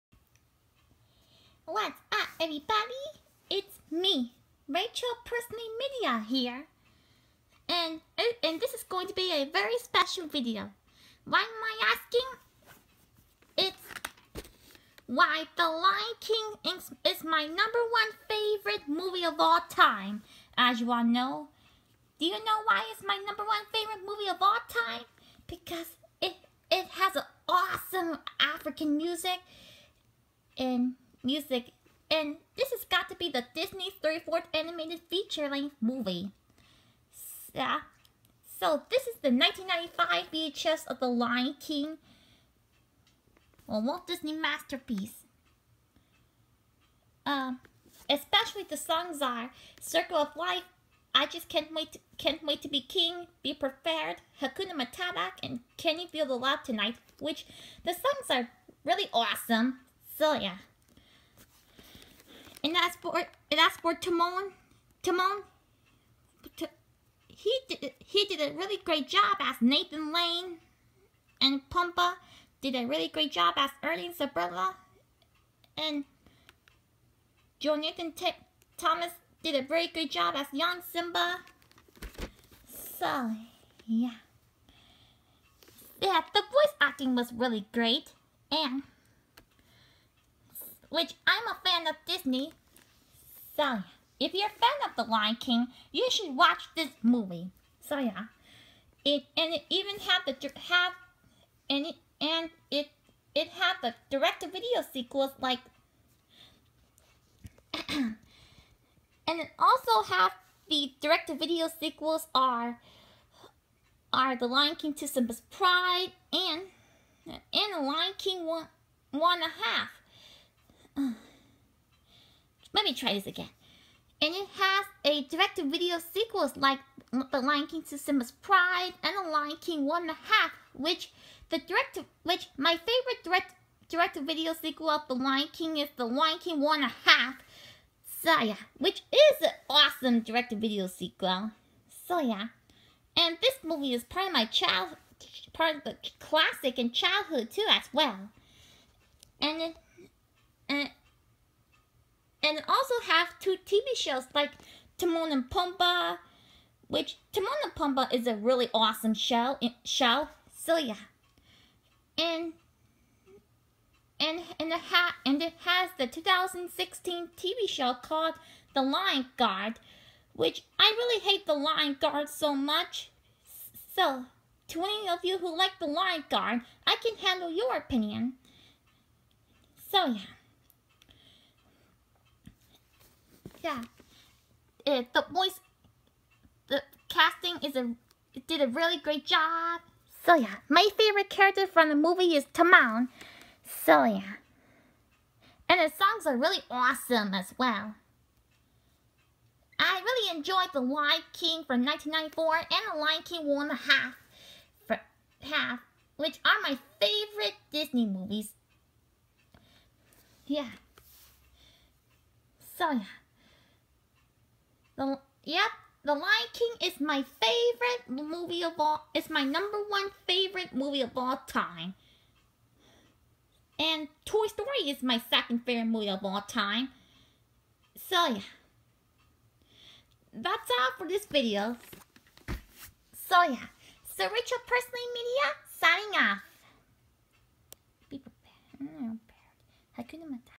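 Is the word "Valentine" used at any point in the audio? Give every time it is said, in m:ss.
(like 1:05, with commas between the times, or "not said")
not said.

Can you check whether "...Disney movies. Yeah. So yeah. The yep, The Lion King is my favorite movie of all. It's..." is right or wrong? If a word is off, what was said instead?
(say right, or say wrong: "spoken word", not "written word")
right.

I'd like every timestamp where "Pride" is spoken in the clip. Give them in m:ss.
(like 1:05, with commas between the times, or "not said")
1:55, 2:08.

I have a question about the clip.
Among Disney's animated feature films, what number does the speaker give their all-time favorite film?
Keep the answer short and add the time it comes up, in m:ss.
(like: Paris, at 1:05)
34th, at 0:34.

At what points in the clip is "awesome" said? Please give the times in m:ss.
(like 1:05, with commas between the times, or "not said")
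0:27, 0:59, 2:19, 2:38, 3:16.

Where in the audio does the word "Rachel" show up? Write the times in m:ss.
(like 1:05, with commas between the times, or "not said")
0:04, 3:54.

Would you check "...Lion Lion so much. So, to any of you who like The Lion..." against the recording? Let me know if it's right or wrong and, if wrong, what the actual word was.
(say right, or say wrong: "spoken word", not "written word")
wrong: "Guard", not "Lion".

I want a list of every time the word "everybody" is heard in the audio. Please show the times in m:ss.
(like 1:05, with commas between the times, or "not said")
0:02.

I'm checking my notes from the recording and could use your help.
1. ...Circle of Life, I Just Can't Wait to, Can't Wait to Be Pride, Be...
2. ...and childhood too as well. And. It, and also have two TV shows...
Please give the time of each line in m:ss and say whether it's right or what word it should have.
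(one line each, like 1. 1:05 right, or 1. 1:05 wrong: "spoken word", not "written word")
1. 0:49 wrong: "King", not "Pride"
2. 2:26 right.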